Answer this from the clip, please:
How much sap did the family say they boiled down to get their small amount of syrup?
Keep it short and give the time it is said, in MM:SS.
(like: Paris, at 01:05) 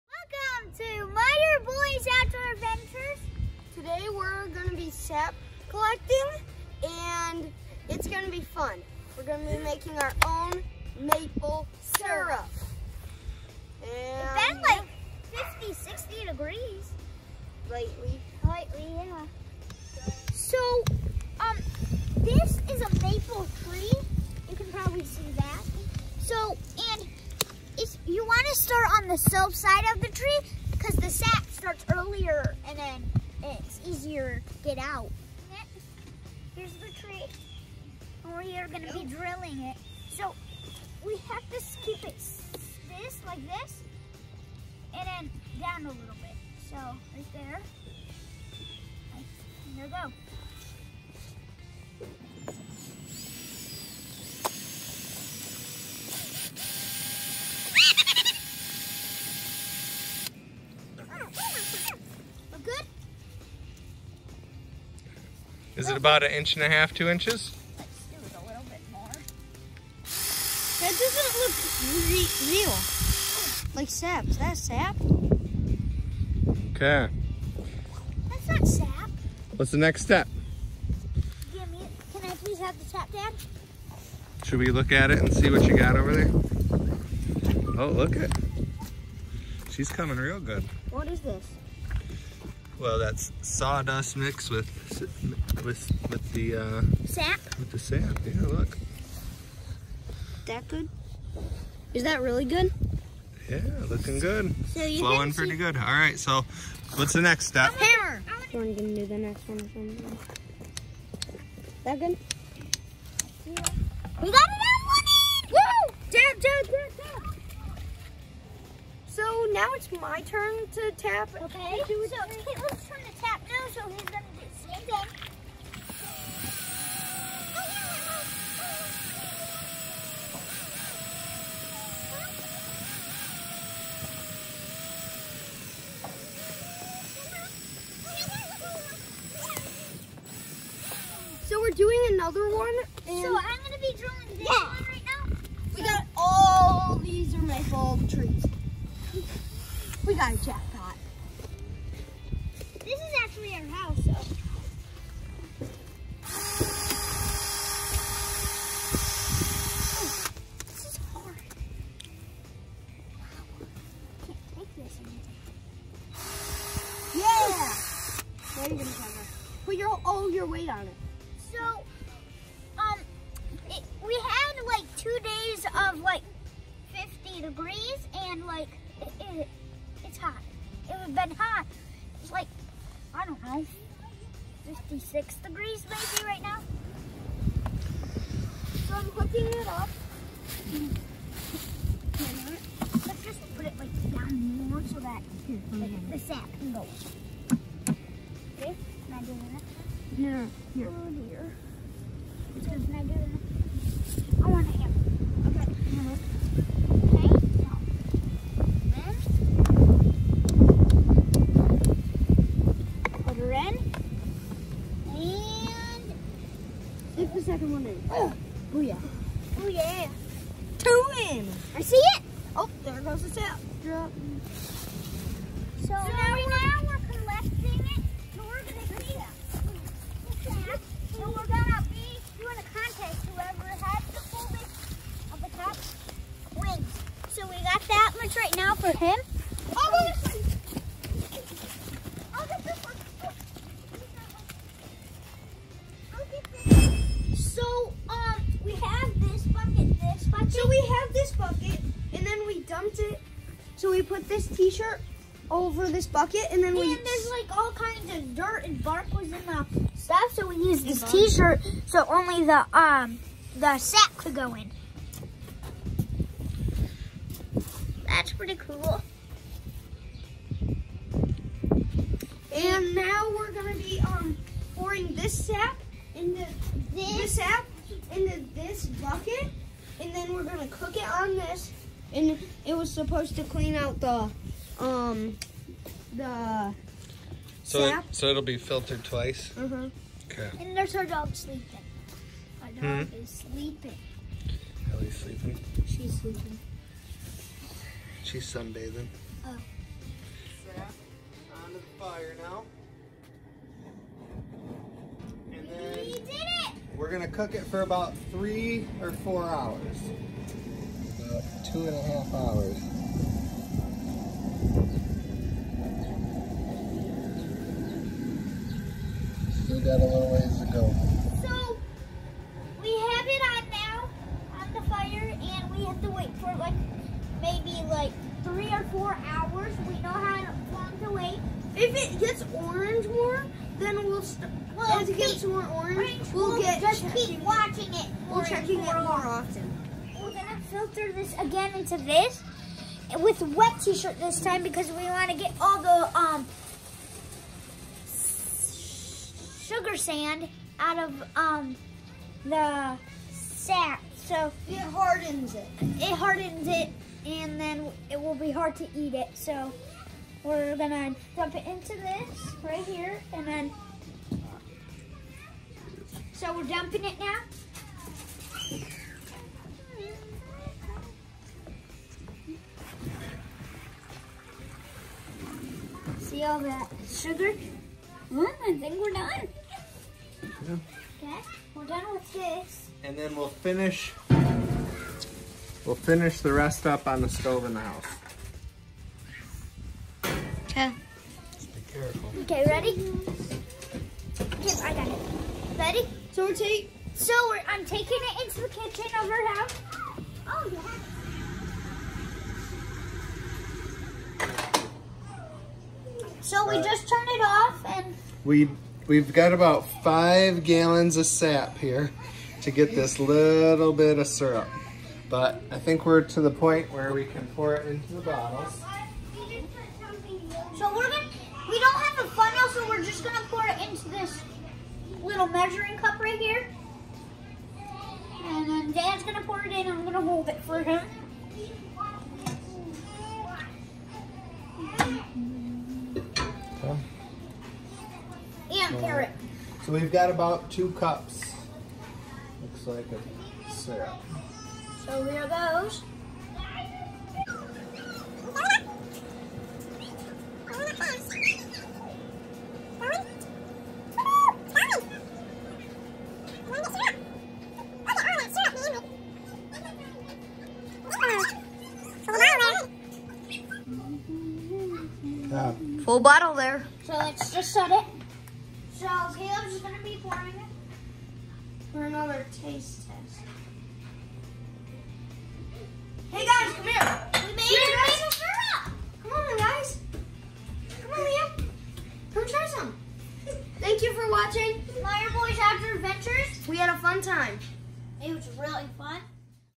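5 gallons, at 06:50.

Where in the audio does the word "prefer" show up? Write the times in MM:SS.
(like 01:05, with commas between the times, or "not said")
not said.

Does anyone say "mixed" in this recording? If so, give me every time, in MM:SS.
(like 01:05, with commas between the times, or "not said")
01:34.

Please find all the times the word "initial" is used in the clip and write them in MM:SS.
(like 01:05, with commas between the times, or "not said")
not said.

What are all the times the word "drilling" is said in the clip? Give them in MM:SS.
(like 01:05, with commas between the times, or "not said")
00:39, 02:23.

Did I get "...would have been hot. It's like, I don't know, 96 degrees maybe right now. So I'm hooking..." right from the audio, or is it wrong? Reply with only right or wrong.
wrong.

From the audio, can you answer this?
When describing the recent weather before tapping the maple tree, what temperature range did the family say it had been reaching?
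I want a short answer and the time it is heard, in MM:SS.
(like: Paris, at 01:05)
50, 60 degrees, at 00:15.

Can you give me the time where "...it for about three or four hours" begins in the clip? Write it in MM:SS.
05:07.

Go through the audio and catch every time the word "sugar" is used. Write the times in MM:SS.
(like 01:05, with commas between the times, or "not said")
05:49, 06:17.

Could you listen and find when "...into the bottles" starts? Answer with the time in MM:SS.
06:57.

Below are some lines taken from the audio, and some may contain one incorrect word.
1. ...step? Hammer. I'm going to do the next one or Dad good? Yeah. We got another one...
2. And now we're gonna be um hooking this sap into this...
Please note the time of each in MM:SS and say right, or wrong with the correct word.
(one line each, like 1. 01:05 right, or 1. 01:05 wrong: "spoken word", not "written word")
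1. 01:47 wrong: "That", not "Dad"
2. 04:32 wrong: "pouring", not "hooking".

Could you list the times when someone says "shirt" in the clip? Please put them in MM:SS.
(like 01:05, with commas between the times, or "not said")
04:14, 04:21, 05:43.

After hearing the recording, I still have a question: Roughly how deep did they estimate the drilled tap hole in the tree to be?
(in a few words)
inch and a half, two inches.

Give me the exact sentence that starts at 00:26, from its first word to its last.
So, and if you want to start on the soap side of the tree, here.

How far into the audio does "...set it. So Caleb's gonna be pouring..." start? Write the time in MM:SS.
07:47.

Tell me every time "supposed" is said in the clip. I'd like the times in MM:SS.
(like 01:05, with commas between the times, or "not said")
04:42.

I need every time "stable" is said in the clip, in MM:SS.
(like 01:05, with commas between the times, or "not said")
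not said.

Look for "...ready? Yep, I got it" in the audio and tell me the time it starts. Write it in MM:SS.
06:32.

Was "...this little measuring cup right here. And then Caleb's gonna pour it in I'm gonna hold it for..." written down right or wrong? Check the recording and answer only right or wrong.
wrong.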